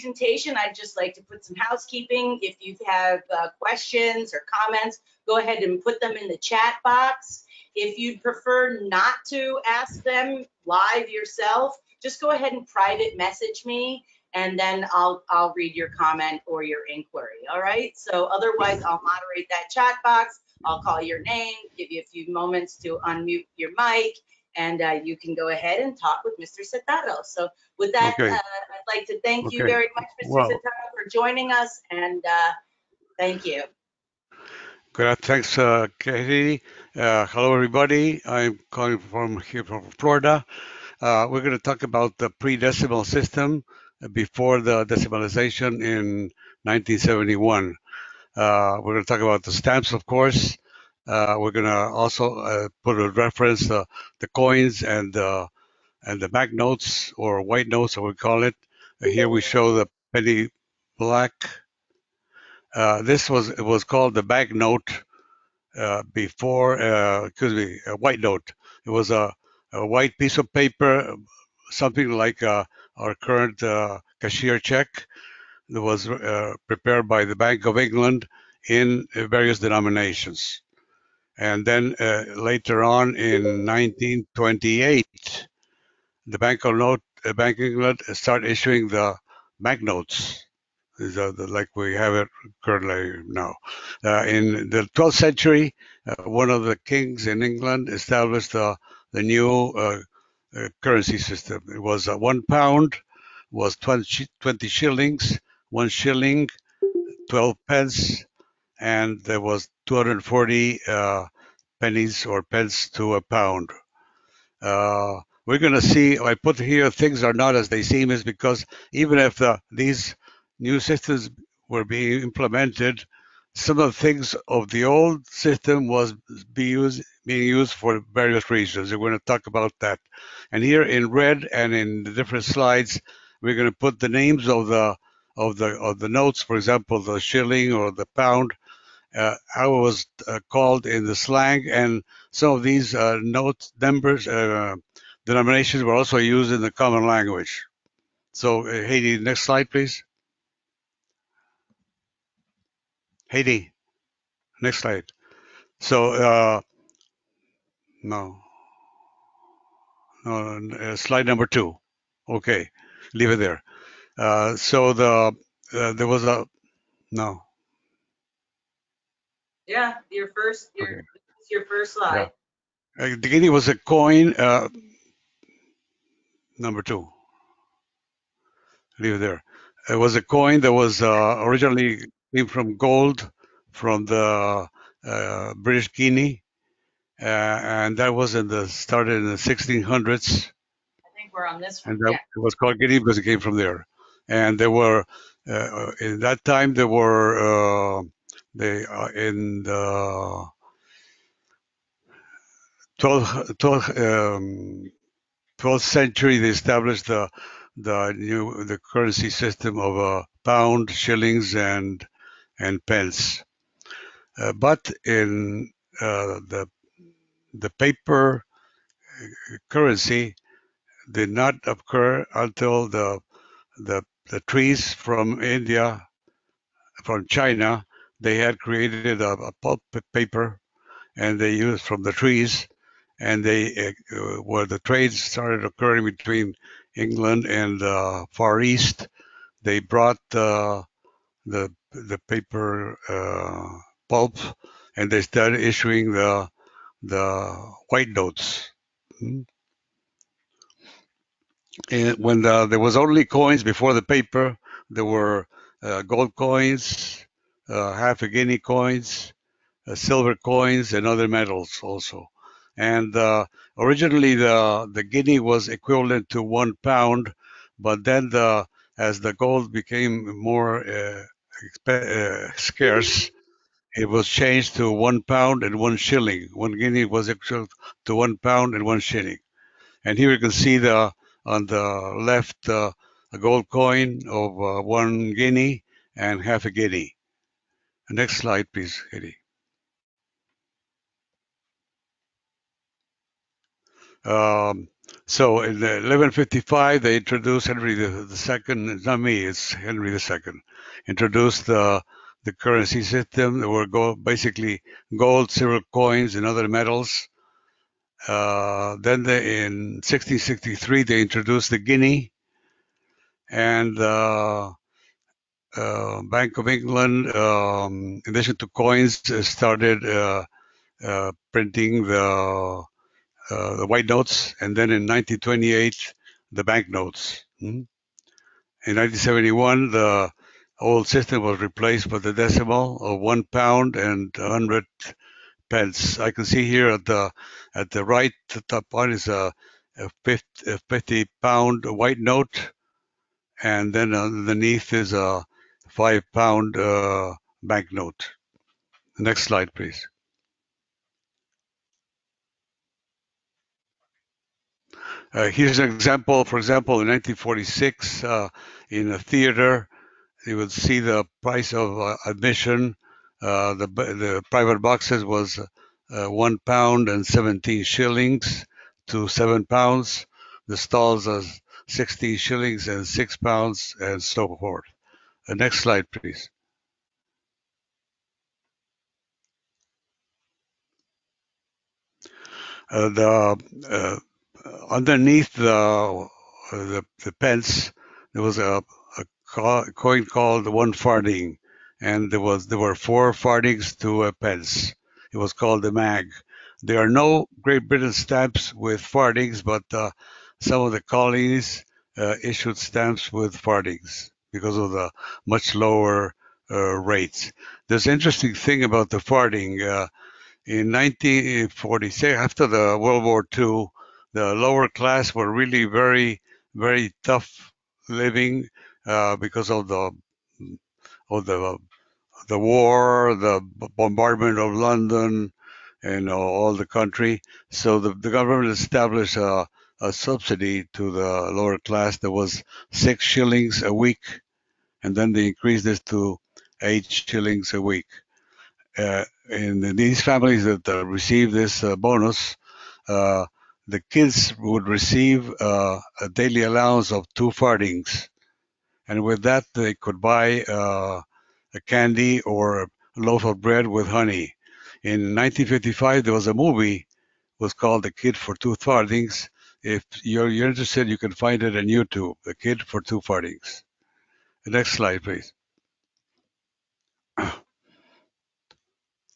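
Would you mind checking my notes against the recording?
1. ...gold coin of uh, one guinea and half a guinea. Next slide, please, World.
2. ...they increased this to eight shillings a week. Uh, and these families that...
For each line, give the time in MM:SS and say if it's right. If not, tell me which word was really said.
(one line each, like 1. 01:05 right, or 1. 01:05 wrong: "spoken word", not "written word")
1. 04:43 wrong: "Eddie", not "World"
2. 07:15 right.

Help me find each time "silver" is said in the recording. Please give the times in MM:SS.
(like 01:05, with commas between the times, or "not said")
04:19, 05:05.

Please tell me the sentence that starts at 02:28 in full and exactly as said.
So, Heidi, uh, next slide, please.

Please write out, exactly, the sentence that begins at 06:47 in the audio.
There's an interesting thing about the farthing.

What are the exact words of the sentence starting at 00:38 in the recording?
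I'm calling from here from Florida.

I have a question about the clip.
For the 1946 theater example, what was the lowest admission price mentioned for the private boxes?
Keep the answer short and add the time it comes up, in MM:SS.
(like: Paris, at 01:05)
1 pound 17 shillings, at 06:06.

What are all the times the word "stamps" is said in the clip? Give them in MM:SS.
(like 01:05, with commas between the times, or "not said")
00:49, 06:38, 06:42.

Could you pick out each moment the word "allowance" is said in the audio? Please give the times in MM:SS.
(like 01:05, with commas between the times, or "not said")
07:26.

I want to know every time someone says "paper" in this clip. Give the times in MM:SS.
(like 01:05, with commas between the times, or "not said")
01:10, 03:37, 03:50, 04:02, 04:14.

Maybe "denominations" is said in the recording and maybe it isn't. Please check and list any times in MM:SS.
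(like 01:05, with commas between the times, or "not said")
01:19, 02:25.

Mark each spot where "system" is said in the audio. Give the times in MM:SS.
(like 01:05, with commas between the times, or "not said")
00:43, 01:41, 02:00, 02:05, 03:29, 05:03, 05:31.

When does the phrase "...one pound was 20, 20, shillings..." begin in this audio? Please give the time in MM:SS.
01:42.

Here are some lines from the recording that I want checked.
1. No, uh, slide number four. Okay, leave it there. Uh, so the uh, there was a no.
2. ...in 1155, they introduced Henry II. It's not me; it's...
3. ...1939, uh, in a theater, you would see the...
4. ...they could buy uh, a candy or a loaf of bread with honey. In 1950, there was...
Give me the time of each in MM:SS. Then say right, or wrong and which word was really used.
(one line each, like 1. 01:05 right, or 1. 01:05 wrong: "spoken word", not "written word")
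1. 02:40 wrong: "two", not "four"
2. 04:55 right
3. 05:57 wrong: "1946", not "1939"
4. 07:29 wrong: "1955", not "1950".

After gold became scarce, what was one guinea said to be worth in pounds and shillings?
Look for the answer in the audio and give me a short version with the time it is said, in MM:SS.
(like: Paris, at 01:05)
1 pound and 1 shilling, at 04:36.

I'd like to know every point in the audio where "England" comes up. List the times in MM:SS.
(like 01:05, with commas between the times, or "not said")
01:17, 01:27, 01:37, 03:56, 05:16.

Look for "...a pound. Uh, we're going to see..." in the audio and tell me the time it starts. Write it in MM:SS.
01:53.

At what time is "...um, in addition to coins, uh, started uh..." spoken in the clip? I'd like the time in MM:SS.
05:17.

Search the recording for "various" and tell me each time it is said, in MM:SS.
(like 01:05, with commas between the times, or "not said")
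01:19, 02:08.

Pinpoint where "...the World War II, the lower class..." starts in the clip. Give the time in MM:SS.
06:52.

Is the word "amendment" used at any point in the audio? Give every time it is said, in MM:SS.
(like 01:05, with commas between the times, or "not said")
not said.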